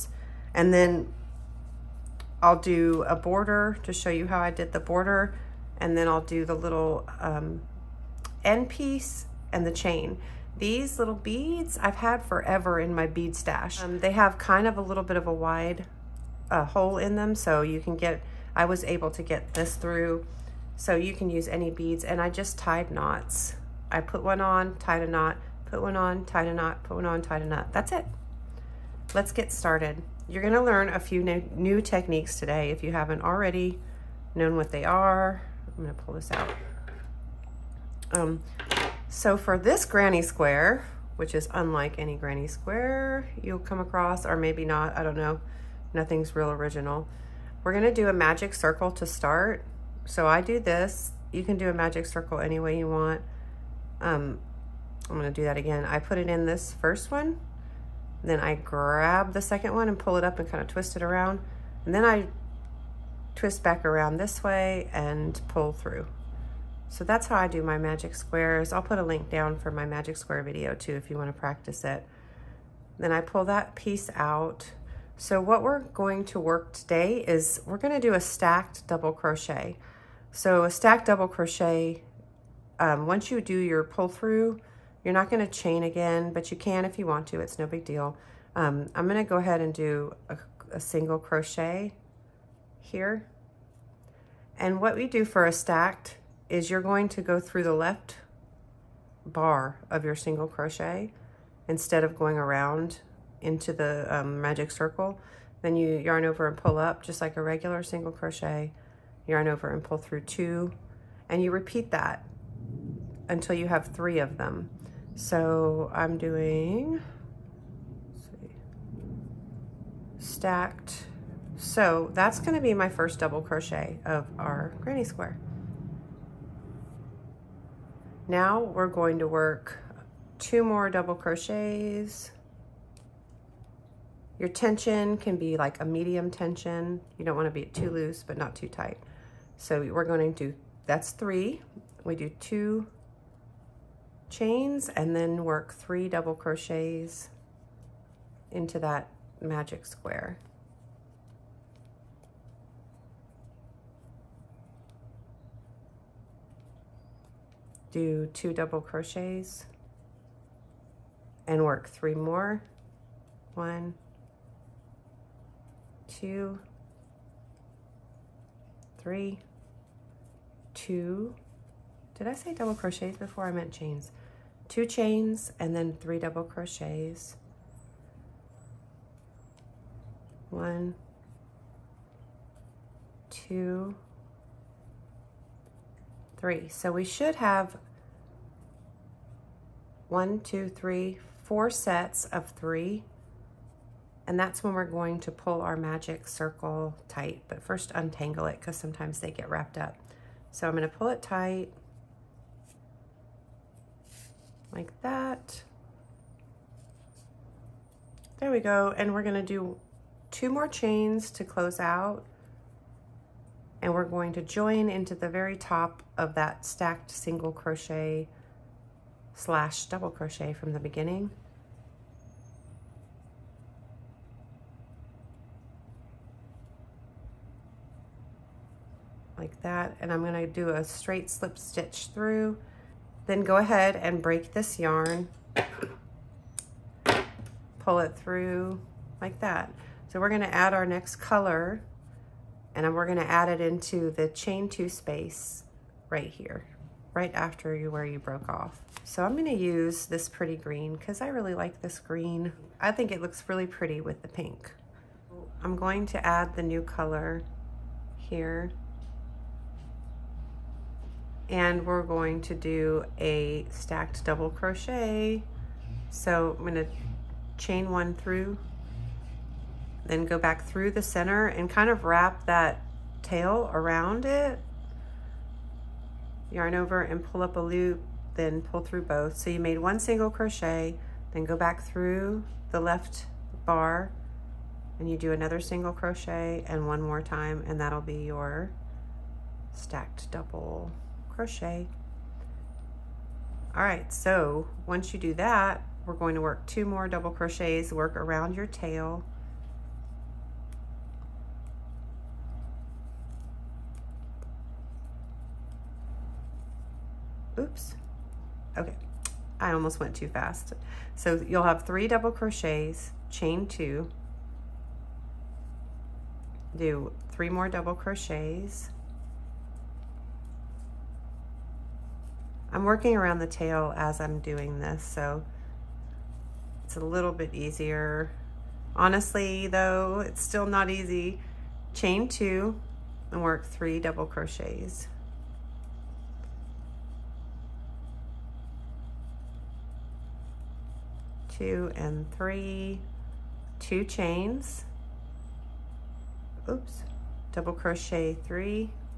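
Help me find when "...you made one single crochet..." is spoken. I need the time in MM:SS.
04:39.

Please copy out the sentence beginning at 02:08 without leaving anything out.
Now we're going to work two more double crochets.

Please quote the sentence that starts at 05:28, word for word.
Honestly, though, it's still not easy.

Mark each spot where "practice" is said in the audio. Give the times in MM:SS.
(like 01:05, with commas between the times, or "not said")
01:11.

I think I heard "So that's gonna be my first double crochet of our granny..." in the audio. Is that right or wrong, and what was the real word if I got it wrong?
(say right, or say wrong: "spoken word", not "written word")
right.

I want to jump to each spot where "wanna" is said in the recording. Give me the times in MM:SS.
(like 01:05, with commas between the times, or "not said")
01:11, 02:17.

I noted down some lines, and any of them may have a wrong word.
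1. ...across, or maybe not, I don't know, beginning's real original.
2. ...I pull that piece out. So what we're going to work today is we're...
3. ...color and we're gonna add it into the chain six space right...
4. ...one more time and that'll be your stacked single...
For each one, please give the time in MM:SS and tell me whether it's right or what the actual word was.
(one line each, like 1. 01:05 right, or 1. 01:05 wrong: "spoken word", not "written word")
1. 00:43 wrong: "nothing", not "beginning"
2. 01:13 right
3. 04:01 wrong: "two", not "six"
4. 04:46 wrong: "double", not "single".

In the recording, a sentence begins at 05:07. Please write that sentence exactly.
Oops, okay, I almost went too fast.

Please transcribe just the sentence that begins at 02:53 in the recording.
I meant chains two chains and then three double crochets.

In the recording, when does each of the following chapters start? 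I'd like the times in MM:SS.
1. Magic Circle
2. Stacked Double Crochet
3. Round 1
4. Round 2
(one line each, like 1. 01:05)
1. 00:41
2. 01:30
3. 01:48
4. 03:54.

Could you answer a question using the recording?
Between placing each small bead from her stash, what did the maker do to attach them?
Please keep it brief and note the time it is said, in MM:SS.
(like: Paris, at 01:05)
Tied knots, at 00:22.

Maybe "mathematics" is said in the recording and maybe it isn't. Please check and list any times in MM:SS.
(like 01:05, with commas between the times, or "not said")
not said.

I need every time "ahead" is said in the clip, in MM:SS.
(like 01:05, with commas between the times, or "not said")
01:29, 03:53.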